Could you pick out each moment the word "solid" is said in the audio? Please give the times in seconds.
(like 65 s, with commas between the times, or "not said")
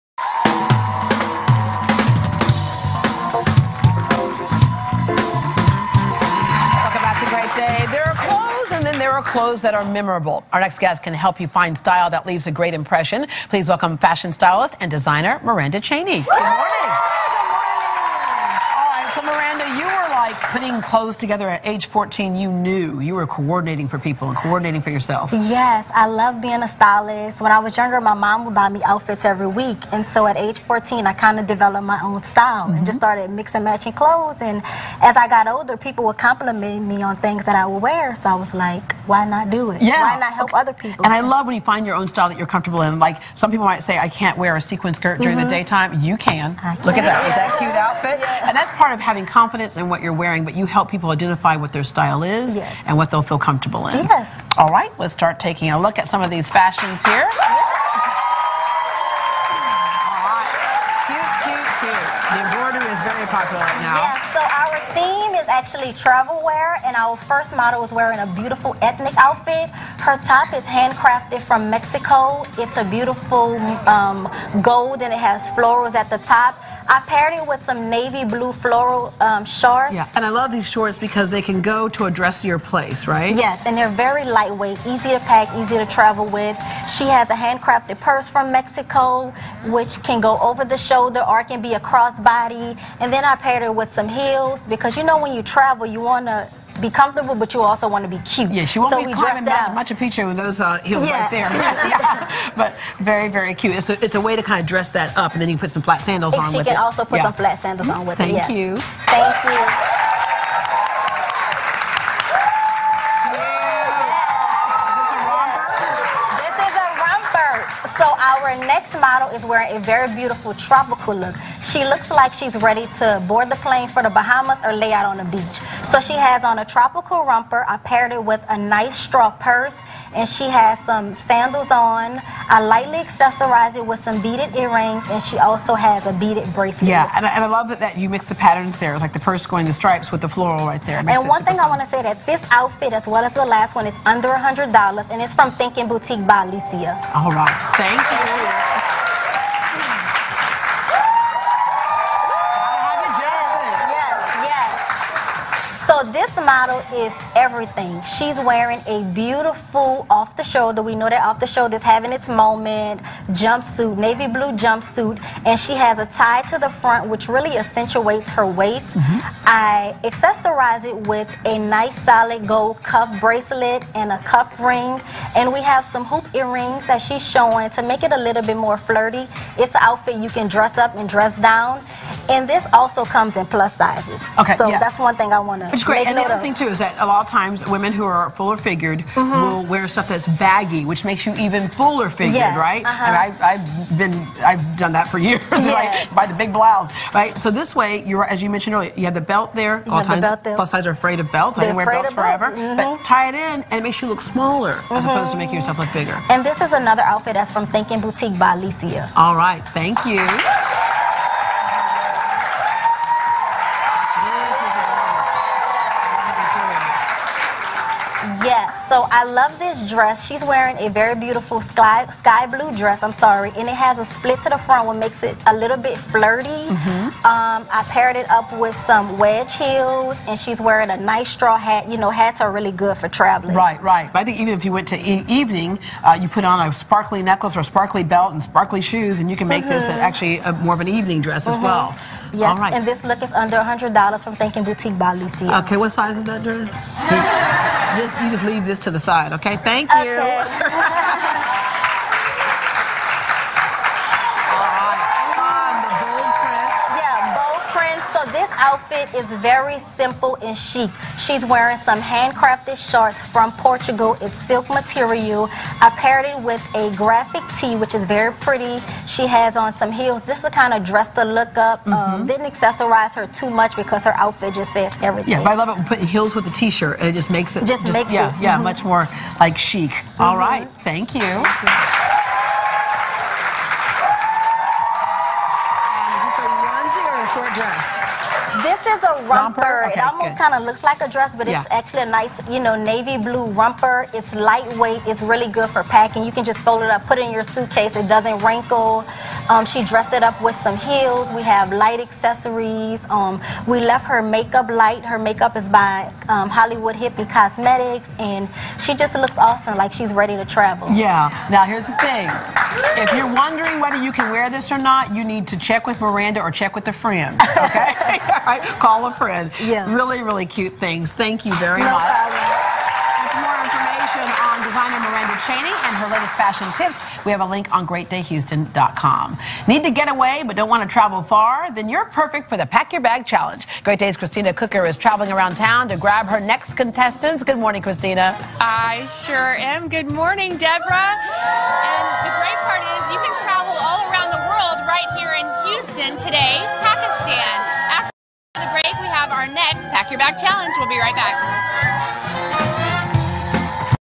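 172 s.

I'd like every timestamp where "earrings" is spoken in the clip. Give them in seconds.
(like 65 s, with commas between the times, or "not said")
134 s, 176 s.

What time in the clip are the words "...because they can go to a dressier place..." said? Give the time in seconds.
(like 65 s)
80 s.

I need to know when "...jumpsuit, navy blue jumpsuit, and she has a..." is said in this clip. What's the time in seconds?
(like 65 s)
163 s.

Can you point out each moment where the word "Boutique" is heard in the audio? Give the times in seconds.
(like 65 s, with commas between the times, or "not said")
145 s, 208 s, 244 s.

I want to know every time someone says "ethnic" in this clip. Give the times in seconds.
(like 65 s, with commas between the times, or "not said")
68 s.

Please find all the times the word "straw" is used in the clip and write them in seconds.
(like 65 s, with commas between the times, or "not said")
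128 s, 231 s.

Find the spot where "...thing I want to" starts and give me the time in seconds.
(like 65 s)
185 s.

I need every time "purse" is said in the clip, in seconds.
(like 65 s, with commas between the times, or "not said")
88 s, 129 s, 139 s.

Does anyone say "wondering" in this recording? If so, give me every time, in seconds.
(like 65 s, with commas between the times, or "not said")
313 s.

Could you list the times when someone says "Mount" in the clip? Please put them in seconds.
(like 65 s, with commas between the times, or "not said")
99 s.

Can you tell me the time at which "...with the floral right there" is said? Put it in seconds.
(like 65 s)
140 s.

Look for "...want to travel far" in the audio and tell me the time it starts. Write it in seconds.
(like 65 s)
330 s.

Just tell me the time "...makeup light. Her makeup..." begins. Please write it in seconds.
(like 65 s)
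304 s.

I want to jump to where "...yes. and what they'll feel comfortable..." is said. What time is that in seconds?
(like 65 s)
52 s.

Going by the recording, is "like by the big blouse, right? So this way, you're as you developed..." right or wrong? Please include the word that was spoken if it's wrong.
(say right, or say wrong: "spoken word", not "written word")
wrong: "mentioned", not "developed".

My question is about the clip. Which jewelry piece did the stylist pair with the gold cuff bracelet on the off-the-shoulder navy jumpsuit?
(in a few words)
cuff ring.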